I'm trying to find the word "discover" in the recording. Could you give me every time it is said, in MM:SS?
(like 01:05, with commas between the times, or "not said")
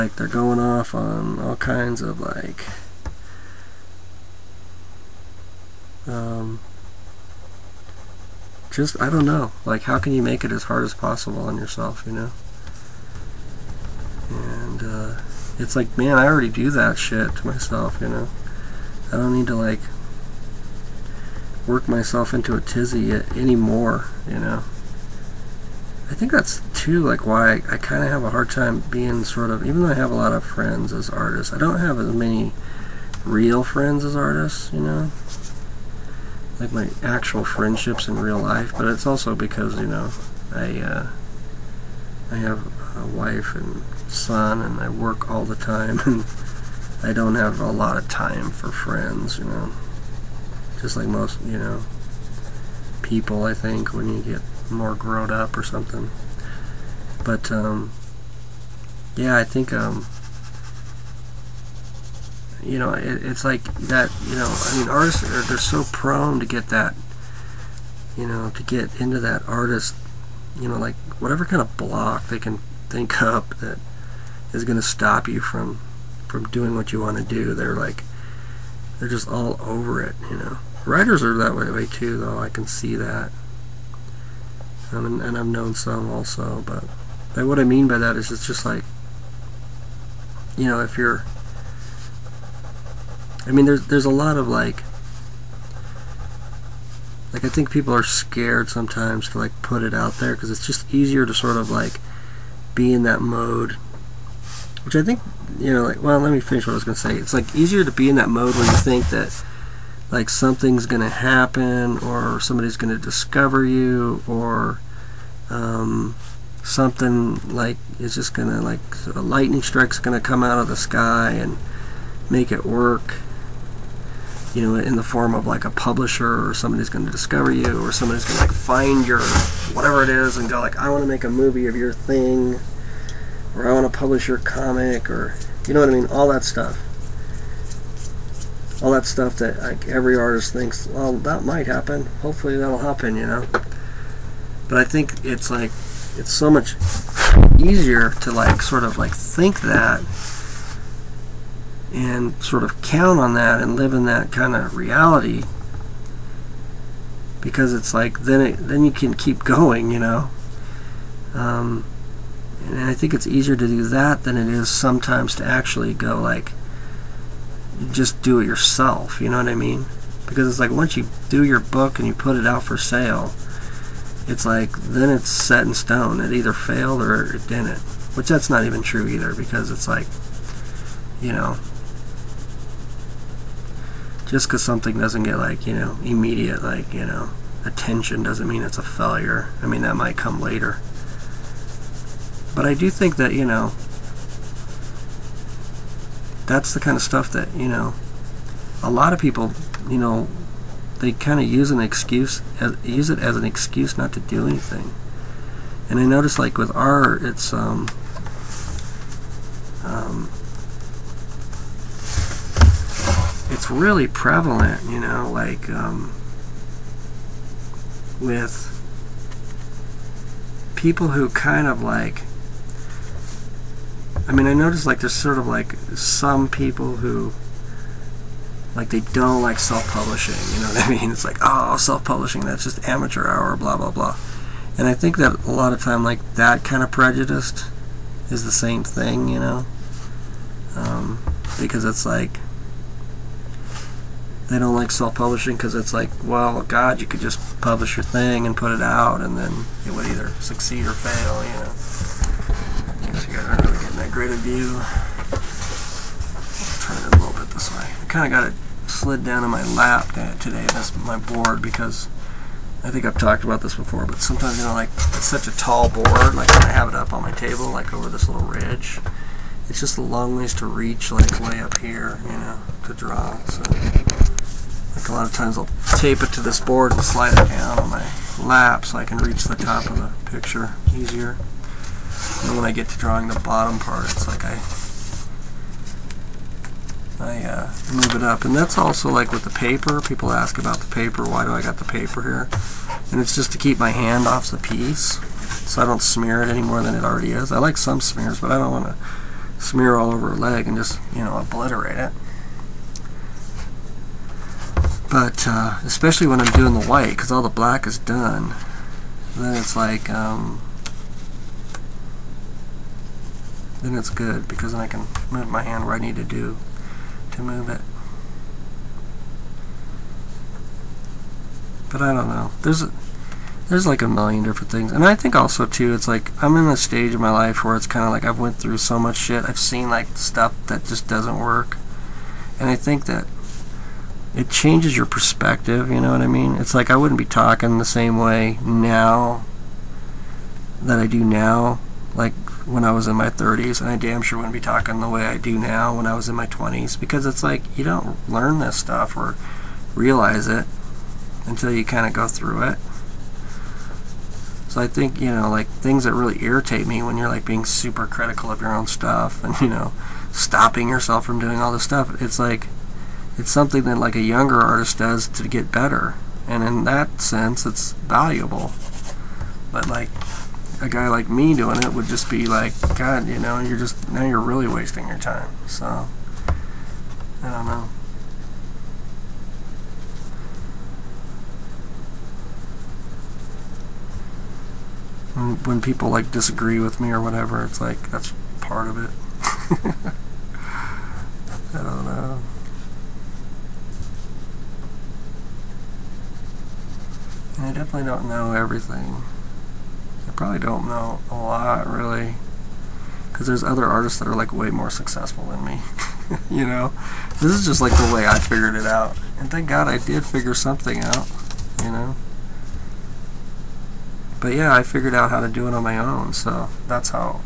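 01:53, 02:07.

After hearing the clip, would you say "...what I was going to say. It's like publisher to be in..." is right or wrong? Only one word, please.
wrong.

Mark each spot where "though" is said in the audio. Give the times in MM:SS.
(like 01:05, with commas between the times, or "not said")
00:29, 01:22.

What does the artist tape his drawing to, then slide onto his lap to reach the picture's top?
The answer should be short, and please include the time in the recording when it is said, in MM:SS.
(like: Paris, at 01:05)
this board, at 04:36.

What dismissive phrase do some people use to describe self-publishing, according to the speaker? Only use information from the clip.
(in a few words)
amateur hour.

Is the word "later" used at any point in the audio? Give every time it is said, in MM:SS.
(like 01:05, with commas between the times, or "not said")
03:10.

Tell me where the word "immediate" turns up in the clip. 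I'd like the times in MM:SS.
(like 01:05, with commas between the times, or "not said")
03:06.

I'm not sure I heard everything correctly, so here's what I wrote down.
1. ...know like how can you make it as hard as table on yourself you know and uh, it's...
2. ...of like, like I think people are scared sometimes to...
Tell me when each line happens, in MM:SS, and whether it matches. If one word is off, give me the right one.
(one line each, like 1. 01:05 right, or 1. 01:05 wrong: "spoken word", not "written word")
1. 00:09 wrong: "possible", not "table"
2. 01:34 right.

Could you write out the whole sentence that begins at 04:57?
I like some smears, but I don't want to smear all over a leg and just, you know, obliterate it.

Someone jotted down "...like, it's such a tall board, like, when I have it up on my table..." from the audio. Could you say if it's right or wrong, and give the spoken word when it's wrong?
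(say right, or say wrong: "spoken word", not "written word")
right.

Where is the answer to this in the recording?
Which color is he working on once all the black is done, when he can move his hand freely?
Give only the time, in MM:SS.
05:06.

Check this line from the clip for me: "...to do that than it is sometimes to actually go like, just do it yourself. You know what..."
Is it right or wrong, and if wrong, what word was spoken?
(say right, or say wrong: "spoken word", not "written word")
right.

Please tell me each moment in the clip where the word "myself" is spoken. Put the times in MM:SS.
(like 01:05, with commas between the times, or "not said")
00:17, 00:21.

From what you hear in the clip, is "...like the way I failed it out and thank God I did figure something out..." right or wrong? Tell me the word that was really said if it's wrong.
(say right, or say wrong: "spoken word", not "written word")
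wrong: "figured", not "failed".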